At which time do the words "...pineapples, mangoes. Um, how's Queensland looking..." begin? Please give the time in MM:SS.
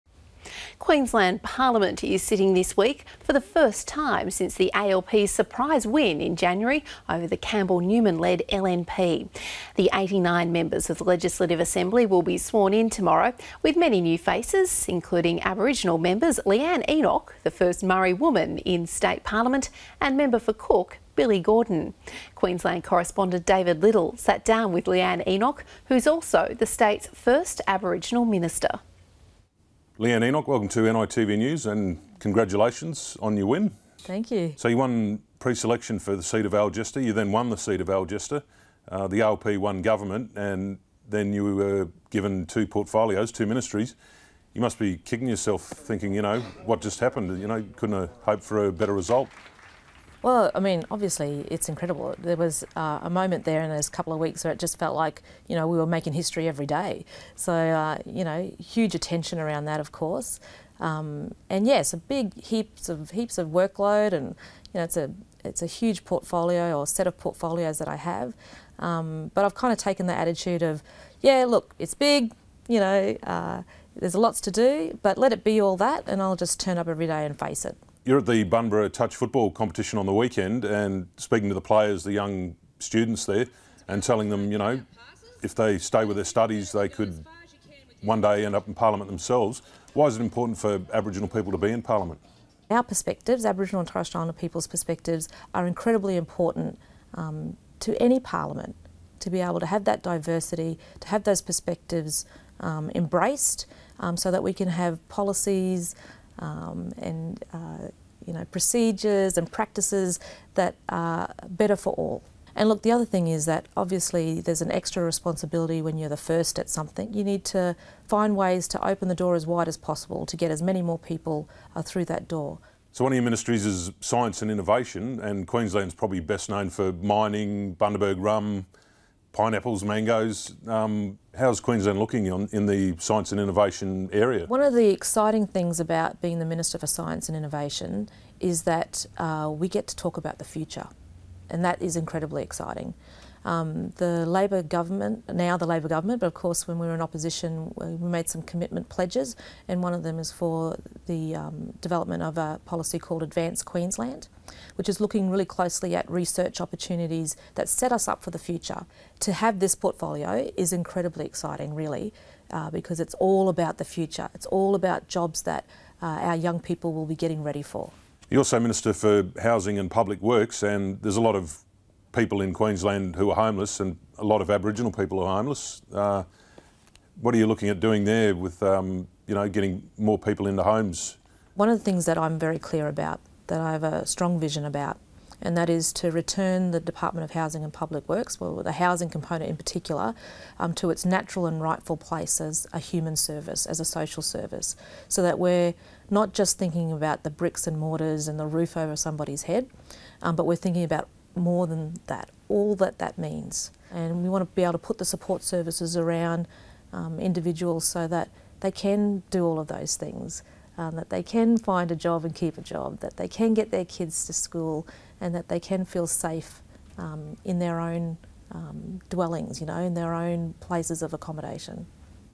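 02:09.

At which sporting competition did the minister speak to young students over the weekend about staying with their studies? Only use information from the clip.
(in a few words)
Bunbury Touch Football.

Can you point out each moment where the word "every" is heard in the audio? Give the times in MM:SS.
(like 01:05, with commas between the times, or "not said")
00:56, 01:16.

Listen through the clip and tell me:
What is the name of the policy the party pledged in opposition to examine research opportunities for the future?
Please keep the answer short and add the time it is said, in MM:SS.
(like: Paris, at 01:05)
Advanced Queensland, at 02:33.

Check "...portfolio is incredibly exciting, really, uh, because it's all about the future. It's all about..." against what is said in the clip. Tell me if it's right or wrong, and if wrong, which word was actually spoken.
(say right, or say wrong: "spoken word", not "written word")
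right.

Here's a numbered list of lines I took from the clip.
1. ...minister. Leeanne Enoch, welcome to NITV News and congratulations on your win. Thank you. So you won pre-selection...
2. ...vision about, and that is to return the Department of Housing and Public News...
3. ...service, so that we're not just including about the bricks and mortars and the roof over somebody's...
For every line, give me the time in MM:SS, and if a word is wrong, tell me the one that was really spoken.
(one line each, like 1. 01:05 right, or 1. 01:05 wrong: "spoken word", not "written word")
1. 00:28 right
2. 03:04 wrong: "Works", not "News"
3. 03:14 wrong: "thinking", not "including".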